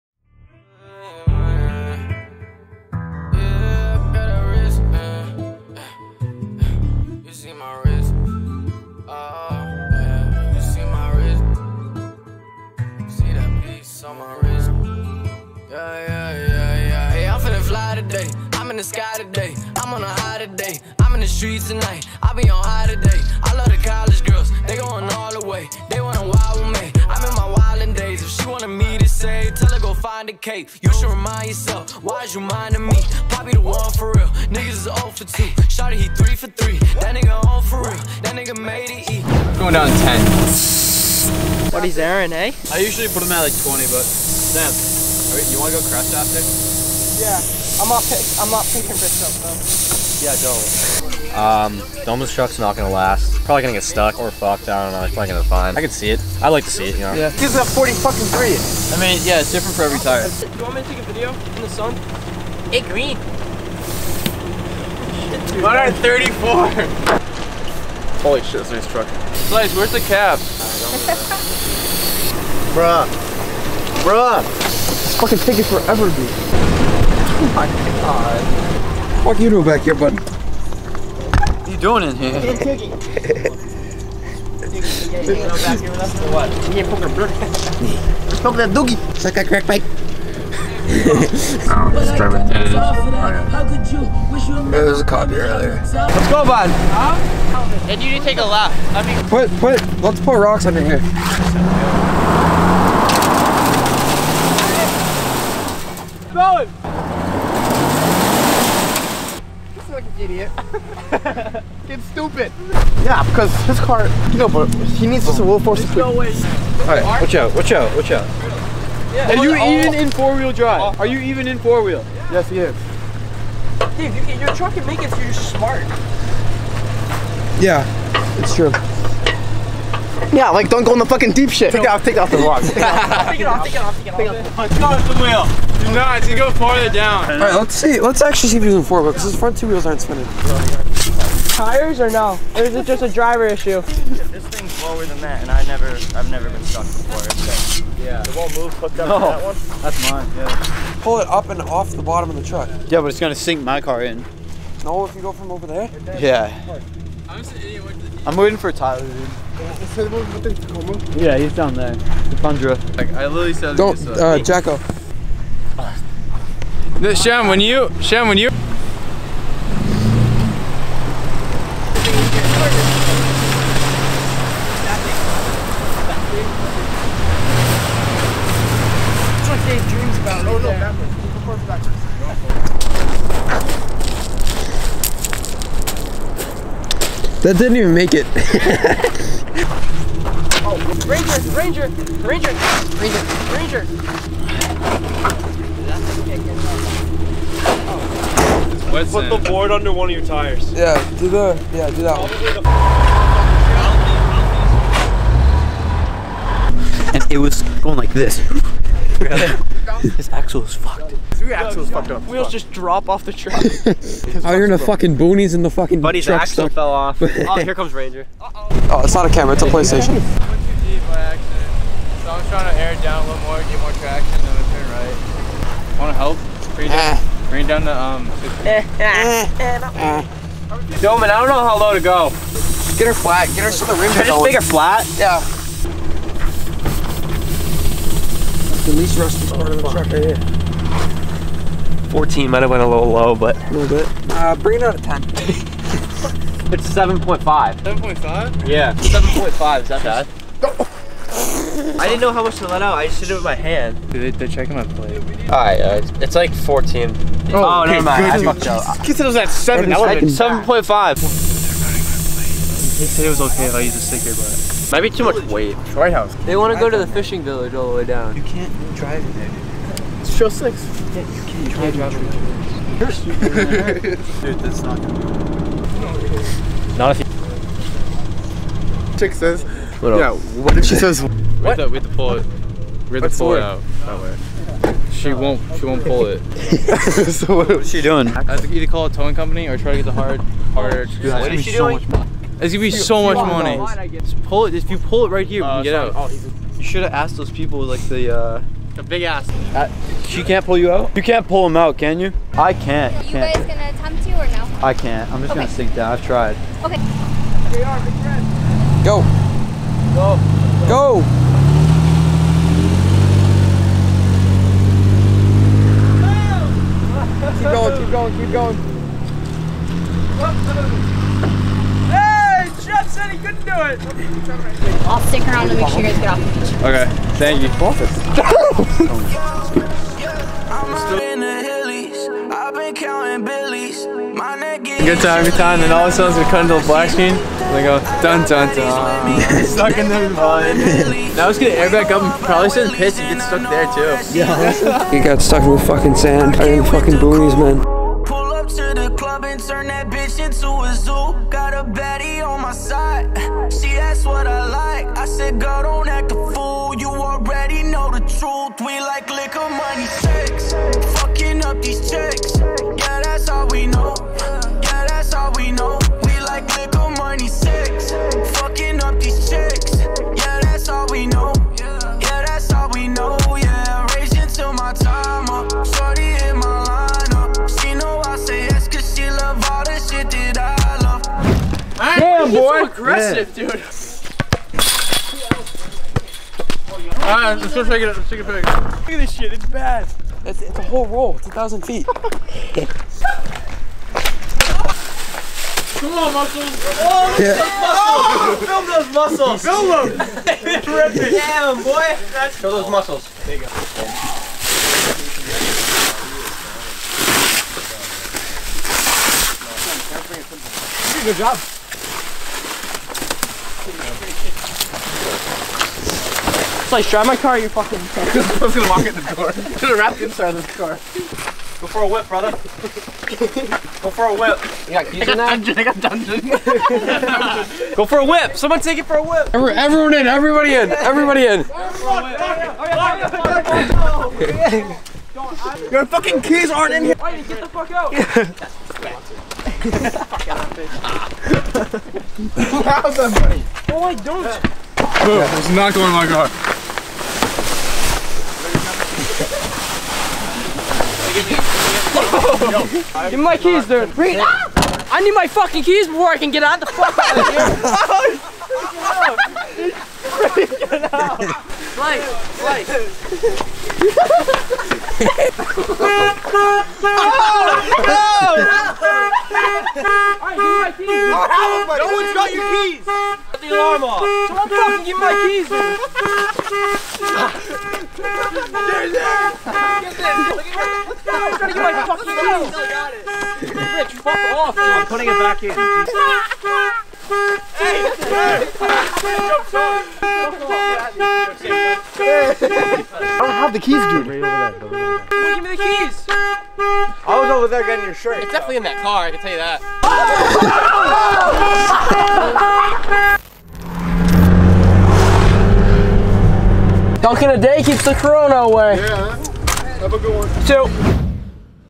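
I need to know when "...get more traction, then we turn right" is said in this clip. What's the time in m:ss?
3:43.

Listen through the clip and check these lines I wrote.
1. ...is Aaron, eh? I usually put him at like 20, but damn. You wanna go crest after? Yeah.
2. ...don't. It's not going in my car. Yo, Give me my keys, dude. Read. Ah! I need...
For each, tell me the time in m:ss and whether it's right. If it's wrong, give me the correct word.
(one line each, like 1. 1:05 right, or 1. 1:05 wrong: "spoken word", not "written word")
1. 0:41 right
2. 7:24 right.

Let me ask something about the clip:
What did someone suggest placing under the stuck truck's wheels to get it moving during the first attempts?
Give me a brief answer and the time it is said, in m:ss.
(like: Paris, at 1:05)
rocks, at 1:40.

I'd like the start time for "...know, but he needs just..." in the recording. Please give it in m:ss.
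1:54.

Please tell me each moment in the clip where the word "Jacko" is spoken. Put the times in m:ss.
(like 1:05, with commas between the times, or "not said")
2:44.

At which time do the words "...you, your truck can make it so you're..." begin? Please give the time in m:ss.
2:04.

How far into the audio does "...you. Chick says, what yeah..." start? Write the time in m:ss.
4:39.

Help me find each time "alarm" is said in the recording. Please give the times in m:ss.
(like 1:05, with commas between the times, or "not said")
7:53.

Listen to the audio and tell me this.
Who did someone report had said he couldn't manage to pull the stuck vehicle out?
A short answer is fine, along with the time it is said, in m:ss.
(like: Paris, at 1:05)
Jeff, at 5:22.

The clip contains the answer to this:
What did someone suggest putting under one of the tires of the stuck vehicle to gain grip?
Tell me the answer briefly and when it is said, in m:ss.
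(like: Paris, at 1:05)
the board, at 3:19.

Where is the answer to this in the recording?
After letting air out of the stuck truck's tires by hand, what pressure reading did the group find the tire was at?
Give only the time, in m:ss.
4:06.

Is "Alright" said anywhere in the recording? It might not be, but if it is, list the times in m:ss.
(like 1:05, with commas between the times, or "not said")
4:15, 6:27.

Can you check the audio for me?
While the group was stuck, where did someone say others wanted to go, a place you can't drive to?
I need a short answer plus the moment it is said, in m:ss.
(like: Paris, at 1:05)
the fishing village, at 4:26.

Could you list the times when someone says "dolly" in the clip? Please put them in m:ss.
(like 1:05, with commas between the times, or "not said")
not said.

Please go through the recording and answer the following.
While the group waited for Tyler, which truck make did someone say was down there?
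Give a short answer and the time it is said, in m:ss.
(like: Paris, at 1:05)
Tundra, at 2:41.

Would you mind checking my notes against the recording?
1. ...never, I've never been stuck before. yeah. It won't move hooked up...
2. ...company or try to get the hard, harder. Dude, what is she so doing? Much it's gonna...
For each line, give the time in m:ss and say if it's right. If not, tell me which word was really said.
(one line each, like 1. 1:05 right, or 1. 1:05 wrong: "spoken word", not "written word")
1. 2:25 right
2. 4:49 right.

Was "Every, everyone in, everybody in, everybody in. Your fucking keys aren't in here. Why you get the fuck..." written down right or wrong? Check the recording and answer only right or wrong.
right.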